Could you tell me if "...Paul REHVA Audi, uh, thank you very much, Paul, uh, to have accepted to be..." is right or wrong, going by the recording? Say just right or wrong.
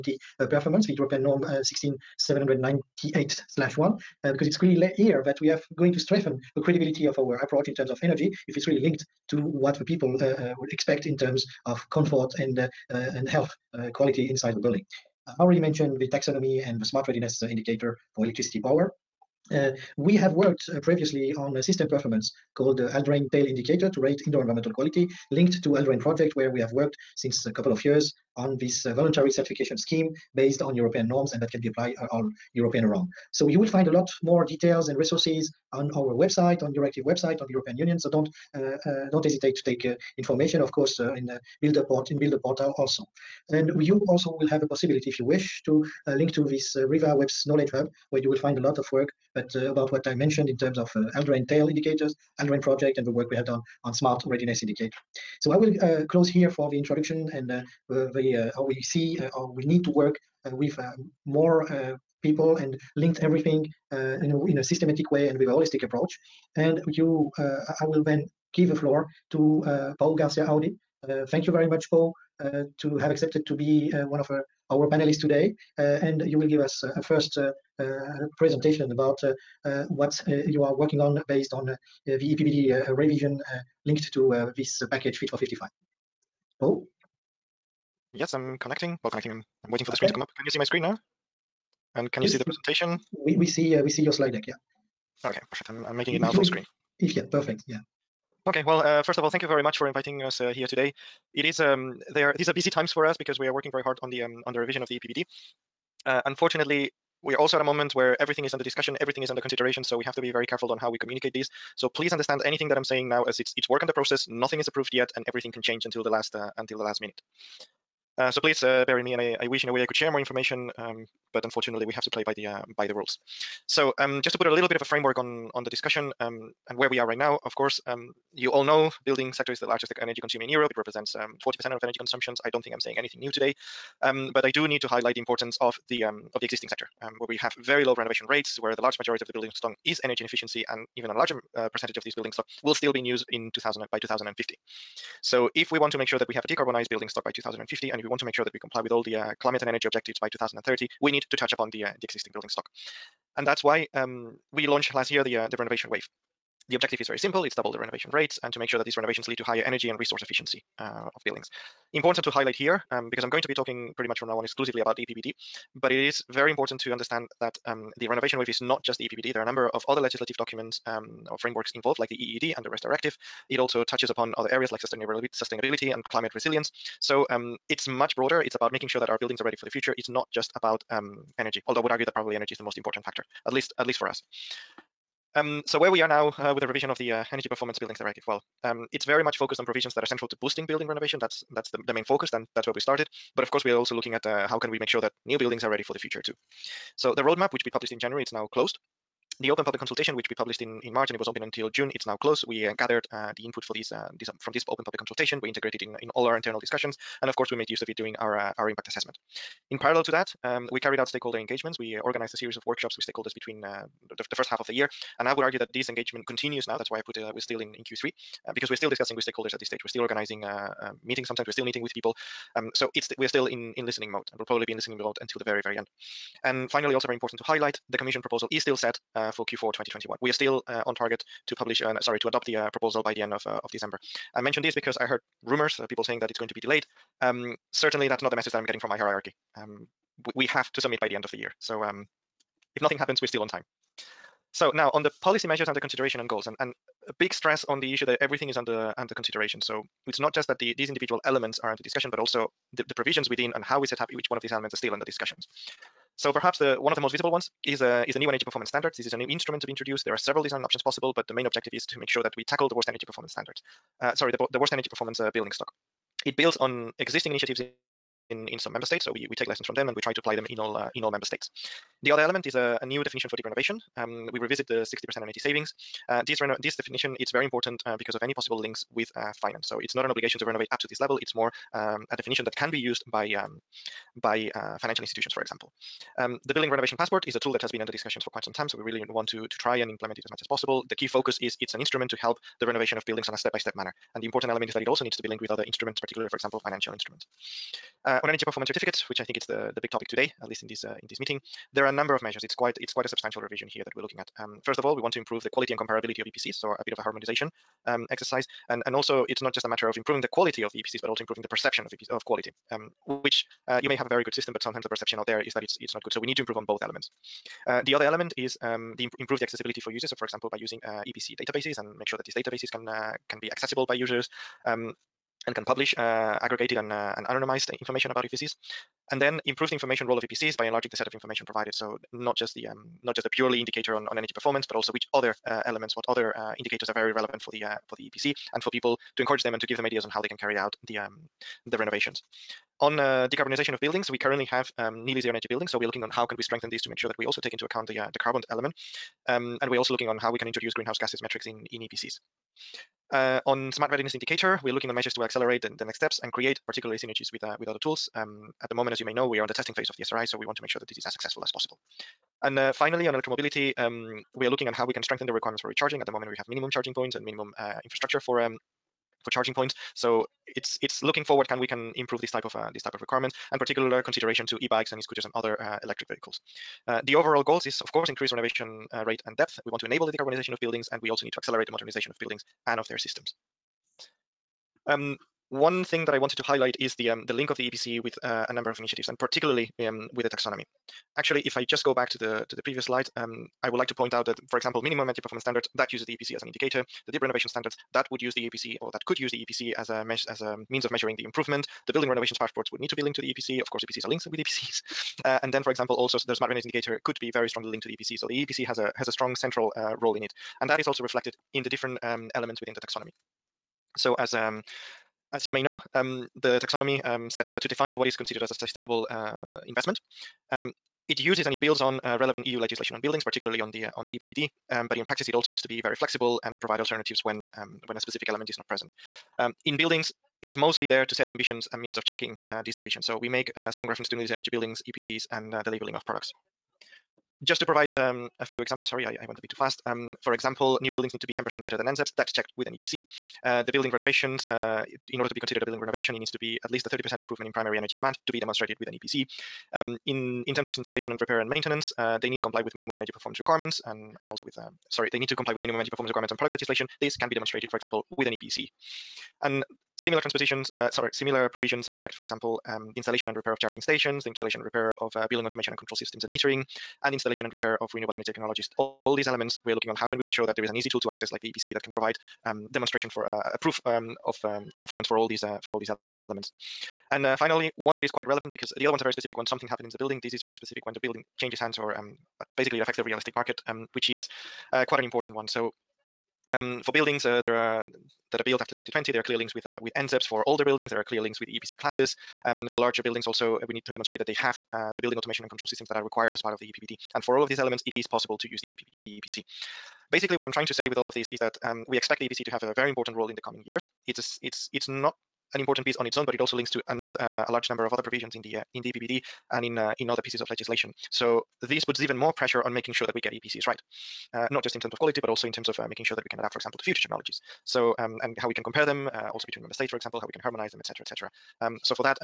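wrong.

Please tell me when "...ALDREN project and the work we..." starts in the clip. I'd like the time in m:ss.
0:52.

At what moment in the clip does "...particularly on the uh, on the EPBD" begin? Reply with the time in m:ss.
7:03.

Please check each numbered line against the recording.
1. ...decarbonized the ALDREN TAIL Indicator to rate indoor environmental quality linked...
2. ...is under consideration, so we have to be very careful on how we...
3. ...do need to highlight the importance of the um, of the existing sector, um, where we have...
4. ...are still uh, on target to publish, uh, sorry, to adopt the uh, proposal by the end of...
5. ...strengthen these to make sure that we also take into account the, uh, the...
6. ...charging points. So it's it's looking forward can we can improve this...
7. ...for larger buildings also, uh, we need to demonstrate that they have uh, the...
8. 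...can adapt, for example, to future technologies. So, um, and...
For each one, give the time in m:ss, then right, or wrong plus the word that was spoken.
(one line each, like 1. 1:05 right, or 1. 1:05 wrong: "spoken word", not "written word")
1. 0:22 wrong: "called", not "decarbonized"
2. 1:49 right
3. 2:14 right
4. 3:50 right
5. 5:46 right
6. 6:09 right
7. 8:12 right
8. 8:36 right.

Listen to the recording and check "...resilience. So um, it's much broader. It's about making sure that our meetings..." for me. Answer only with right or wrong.
wrong.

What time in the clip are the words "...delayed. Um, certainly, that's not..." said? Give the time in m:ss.
3:56.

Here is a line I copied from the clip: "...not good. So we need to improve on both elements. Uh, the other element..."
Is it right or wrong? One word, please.
right.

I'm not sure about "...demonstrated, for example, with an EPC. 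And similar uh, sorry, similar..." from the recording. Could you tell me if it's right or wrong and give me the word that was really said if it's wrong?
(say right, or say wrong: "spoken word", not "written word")
right.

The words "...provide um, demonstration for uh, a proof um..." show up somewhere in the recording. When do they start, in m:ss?
7:51.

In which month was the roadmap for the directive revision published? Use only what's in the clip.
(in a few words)
January.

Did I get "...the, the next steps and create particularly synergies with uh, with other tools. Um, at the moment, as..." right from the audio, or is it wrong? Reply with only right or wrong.
right.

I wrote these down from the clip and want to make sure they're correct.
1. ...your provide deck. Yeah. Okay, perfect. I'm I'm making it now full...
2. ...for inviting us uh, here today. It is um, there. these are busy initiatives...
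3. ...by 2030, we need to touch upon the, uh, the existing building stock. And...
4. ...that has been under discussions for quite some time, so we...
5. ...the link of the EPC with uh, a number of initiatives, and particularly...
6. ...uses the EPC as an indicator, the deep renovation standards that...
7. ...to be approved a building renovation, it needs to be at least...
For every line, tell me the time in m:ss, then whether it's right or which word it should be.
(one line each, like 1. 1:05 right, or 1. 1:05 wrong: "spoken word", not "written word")
1. 1:33 wrong: "slide", not "provide"
2. 1:39 wrong: "times", not "initiatives"
3. 2:30 right
4. 4:47 right
5. 6:27 right
6. 6:35 right
7. 7:25 wrong: "considered", not "approved".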